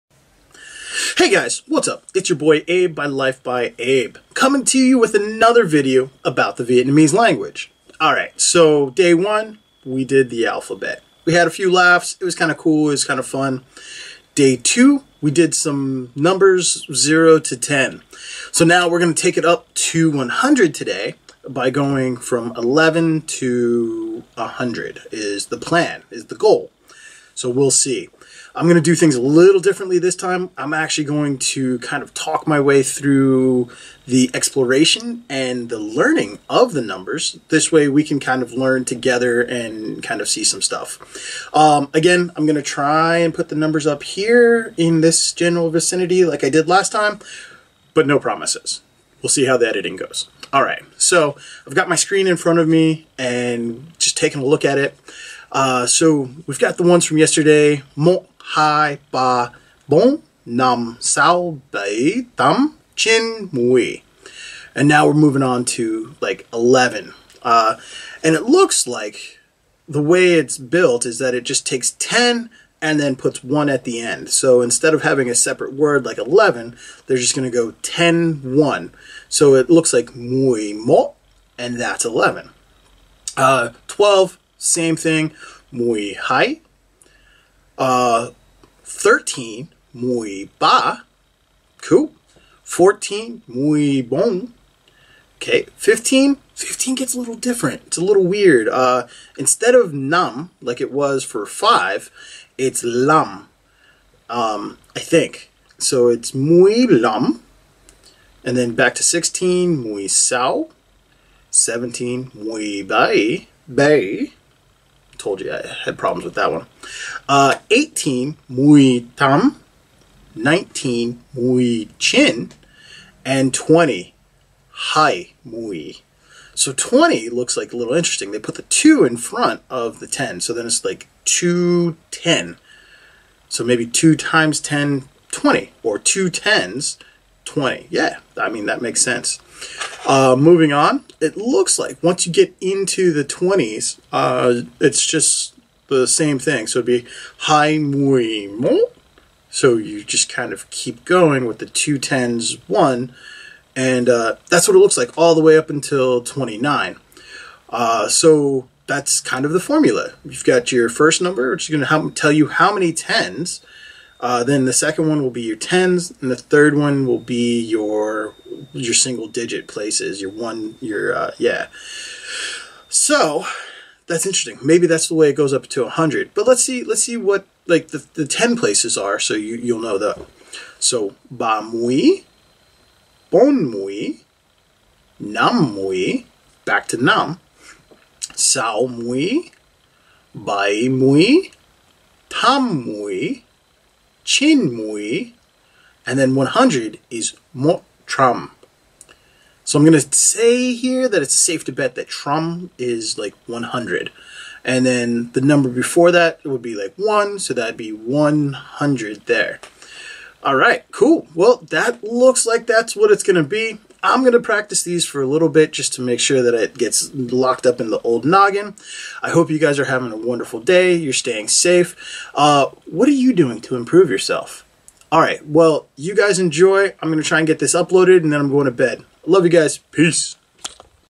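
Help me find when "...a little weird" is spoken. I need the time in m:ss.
1:37.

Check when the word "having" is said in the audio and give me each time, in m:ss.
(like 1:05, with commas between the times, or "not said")
1:15, 3:39.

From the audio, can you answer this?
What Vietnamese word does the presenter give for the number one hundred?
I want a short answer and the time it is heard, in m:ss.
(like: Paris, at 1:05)
motram, at 3:17.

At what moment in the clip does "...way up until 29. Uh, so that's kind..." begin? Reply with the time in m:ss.
2:35.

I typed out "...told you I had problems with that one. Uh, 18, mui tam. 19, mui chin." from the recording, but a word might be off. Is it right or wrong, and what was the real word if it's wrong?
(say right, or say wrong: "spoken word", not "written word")
right.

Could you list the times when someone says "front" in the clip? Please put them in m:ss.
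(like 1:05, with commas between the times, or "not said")
0:52, 2:09.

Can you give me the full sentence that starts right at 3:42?
Uh, what are you doing to improve yourself?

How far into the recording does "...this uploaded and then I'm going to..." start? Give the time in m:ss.
3:47.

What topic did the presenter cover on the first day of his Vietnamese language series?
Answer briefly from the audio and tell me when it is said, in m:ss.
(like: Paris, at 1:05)
The alphabet, at 0:10.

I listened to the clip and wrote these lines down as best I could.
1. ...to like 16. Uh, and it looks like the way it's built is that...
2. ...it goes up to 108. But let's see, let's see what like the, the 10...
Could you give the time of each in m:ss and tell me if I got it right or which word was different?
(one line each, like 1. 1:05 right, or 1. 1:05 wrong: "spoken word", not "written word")
1. 1:05 wrong: "11", not "16"
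2. 2:55 wrong: "100", not "108".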